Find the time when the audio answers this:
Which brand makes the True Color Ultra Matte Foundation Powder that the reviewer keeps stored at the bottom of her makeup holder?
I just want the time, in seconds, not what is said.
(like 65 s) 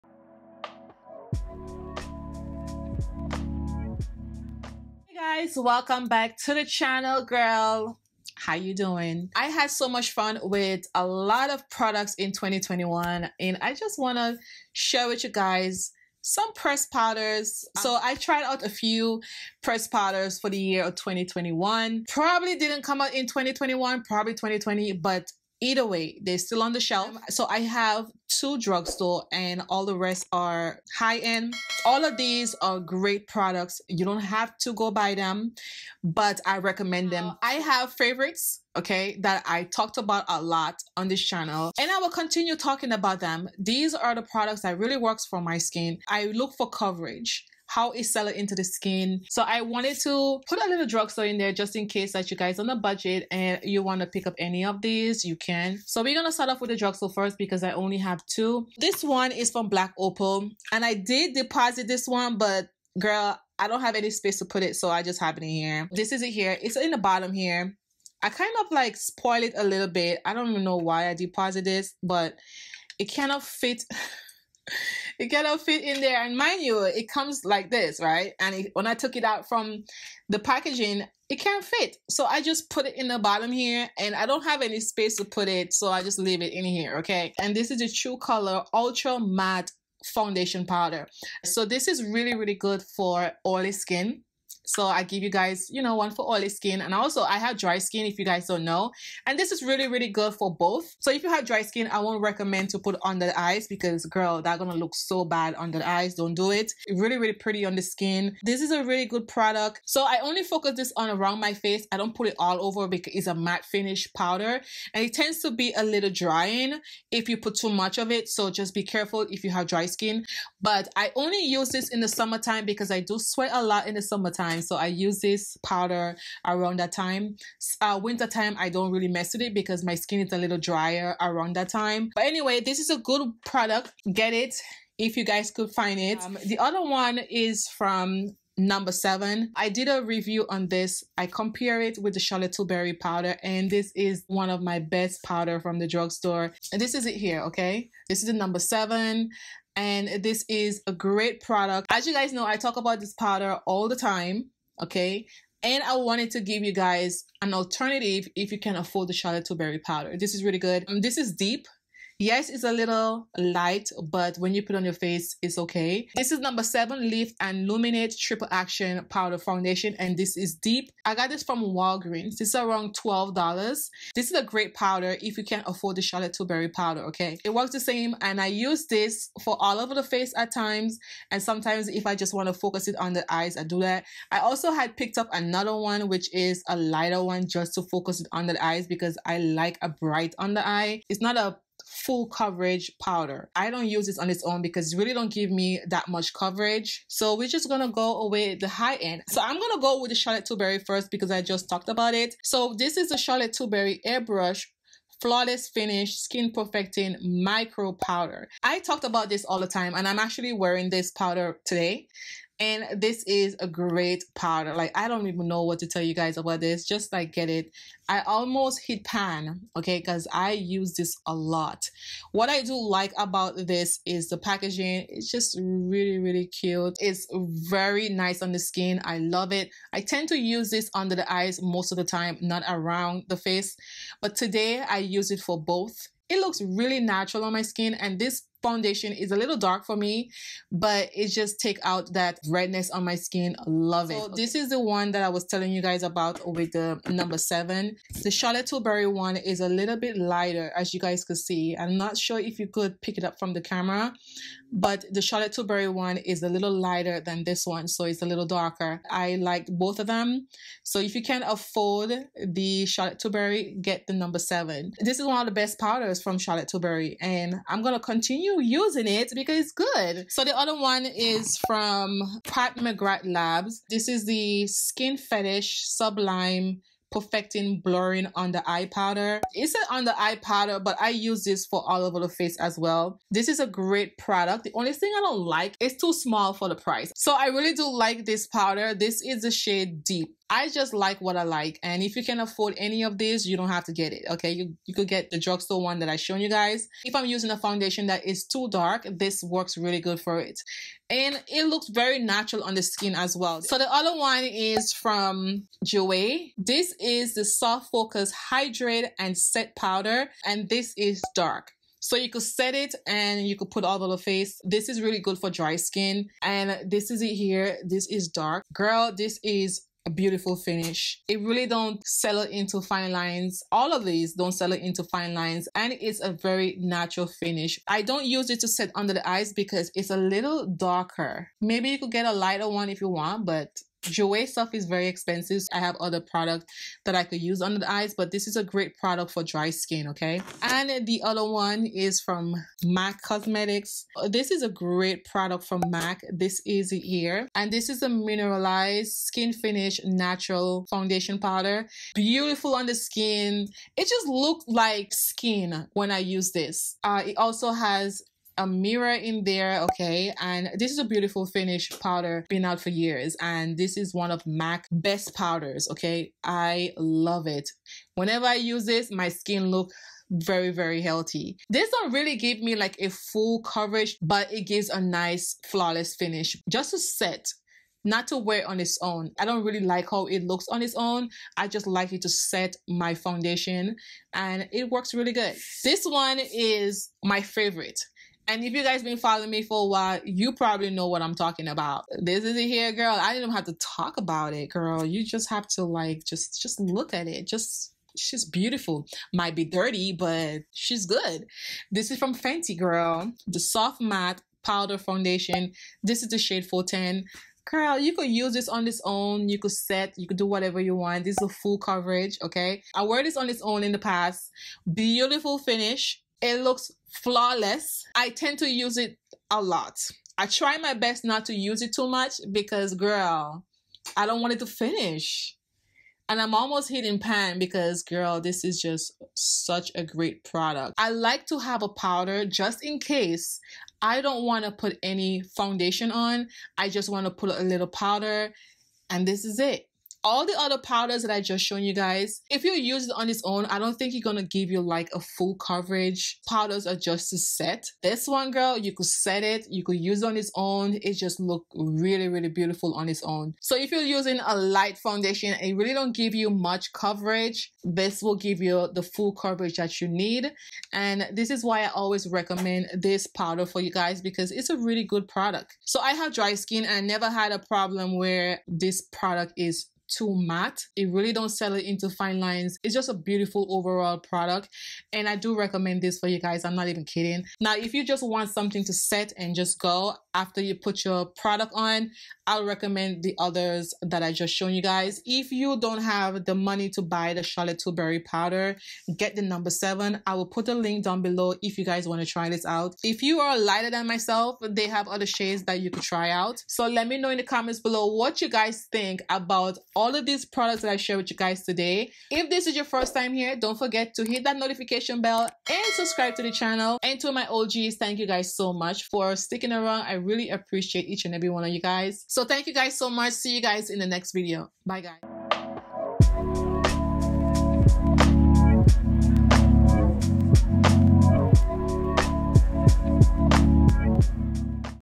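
59 s.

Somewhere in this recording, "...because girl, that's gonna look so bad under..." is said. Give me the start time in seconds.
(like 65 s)
103 s.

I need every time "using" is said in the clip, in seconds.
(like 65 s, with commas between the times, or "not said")
268 s, 297 s, 454 s.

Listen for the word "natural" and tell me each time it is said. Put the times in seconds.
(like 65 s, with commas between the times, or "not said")
236 s, 302 s, 326 s, 350 s.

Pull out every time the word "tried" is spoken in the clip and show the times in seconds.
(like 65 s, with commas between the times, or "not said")
18 s.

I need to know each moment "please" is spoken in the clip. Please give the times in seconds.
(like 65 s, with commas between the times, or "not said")
not said.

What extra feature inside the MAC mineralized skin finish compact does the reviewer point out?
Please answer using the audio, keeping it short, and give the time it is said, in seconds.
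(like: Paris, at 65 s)
A mirror, at 358 s.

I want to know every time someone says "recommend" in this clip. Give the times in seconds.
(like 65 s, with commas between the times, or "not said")
36 s, 102 s, 462 s, 475 s, 482 s.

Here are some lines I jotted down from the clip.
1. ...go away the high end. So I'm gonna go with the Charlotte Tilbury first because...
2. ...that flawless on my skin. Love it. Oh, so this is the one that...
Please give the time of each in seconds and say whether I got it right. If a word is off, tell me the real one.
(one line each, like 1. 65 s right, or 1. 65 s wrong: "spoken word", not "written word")
1. 197 s right
2. 242 s wrong: "redness", not "flawless".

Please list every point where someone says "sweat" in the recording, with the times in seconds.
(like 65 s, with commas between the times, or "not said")
123 s.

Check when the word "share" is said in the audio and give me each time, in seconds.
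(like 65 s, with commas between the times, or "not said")
14 s, 500 s.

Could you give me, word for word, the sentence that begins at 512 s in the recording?
So thank you guys so much.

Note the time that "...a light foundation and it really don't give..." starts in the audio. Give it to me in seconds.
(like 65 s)
454 s.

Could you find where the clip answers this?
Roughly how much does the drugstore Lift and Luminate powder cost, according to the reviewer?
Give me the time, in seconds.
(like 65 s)
172 s.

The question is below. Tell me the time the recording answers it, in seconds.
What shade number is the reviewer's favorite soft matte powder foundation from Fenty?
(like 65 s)
406 s.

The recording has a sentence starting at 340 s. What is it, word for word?
And the other one is from MAC Cosmetics.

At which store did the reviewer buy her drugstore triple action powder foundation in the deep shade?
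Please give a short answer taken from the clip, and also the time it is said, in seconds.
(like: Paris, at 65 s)
Walgreens, at 171 s.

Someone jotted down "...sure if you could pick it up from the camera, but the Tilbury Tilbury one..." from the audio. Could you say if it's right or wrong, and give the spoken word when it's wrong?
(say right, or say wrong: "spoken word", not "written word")
wrong: "Charlotte", not "Tilbury".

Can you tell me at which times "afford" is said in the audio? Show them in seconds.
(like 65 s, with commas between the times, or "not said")
158 s, 175 s, 261 s, 292 s.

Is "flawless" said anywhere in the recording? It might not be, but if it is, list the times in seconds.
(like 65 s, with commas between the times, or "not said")
205 s, 375 s, 417 s.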